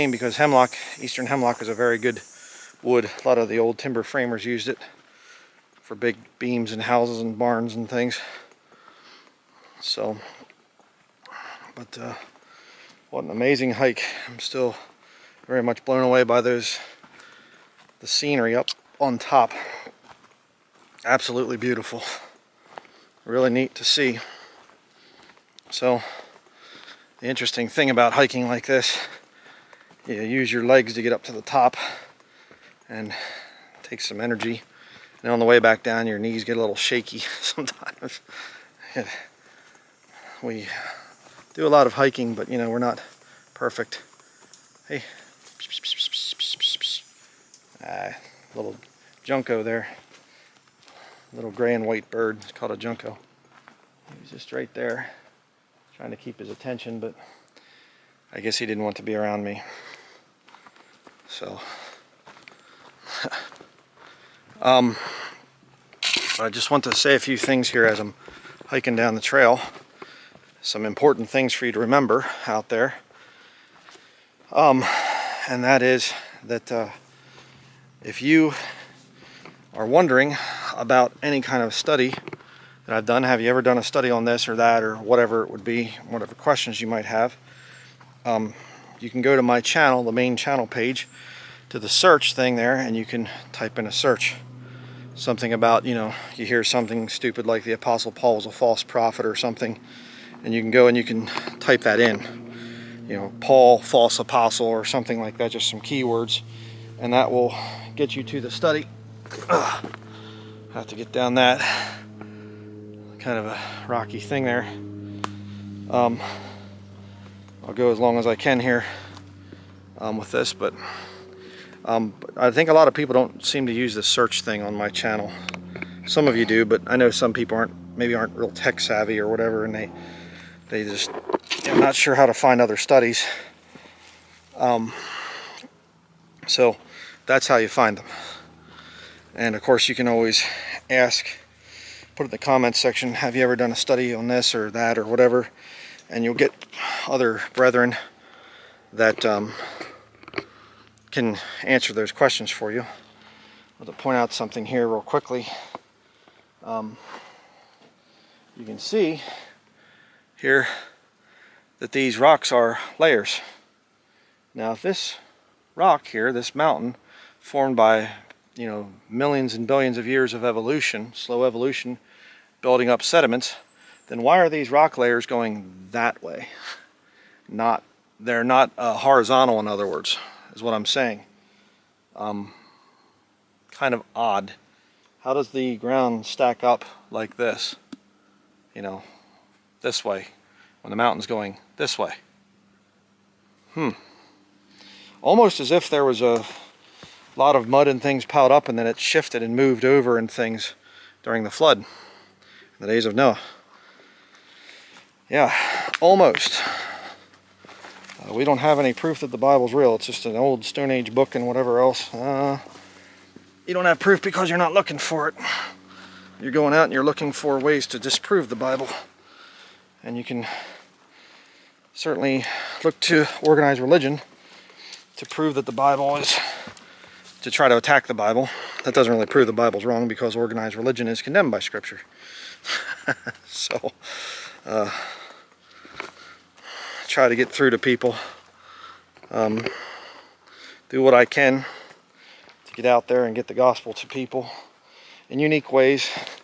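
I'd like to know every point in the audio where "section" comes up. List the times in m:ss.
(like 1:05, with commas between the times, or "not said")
2:22.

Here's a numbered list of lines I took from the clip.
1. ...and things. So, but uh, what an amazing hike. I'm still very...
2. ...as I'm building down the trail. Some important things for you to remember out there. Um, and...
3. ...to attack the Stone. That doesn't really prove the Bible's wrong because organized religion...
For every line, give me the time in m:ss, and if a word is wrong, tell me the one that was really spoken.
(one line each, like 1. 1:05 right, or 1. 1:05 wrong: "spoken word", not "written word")
1. 0:07 right
2. 1:07 wrong: "hiking", not "building"
3. 3:47 wrong: "Bible", not "Stone".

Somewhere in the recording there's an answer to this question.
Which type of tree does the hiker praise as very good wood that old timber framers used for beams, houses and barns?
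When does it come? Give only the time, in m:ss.
0:01.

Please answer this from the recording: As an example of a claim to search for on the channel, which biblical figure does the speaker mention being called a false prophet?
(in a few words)
Apostle Paul.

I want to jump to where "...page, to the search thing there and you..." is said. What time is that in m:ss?
1:30.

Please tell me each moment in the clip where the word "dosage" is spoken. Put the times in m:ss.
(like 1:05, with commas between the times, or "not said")
not said.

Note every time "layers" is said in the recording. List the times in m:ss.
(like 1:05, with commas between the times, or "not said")
2:42, 2:54.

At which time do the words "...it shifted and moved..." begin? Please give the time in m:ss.
3:18.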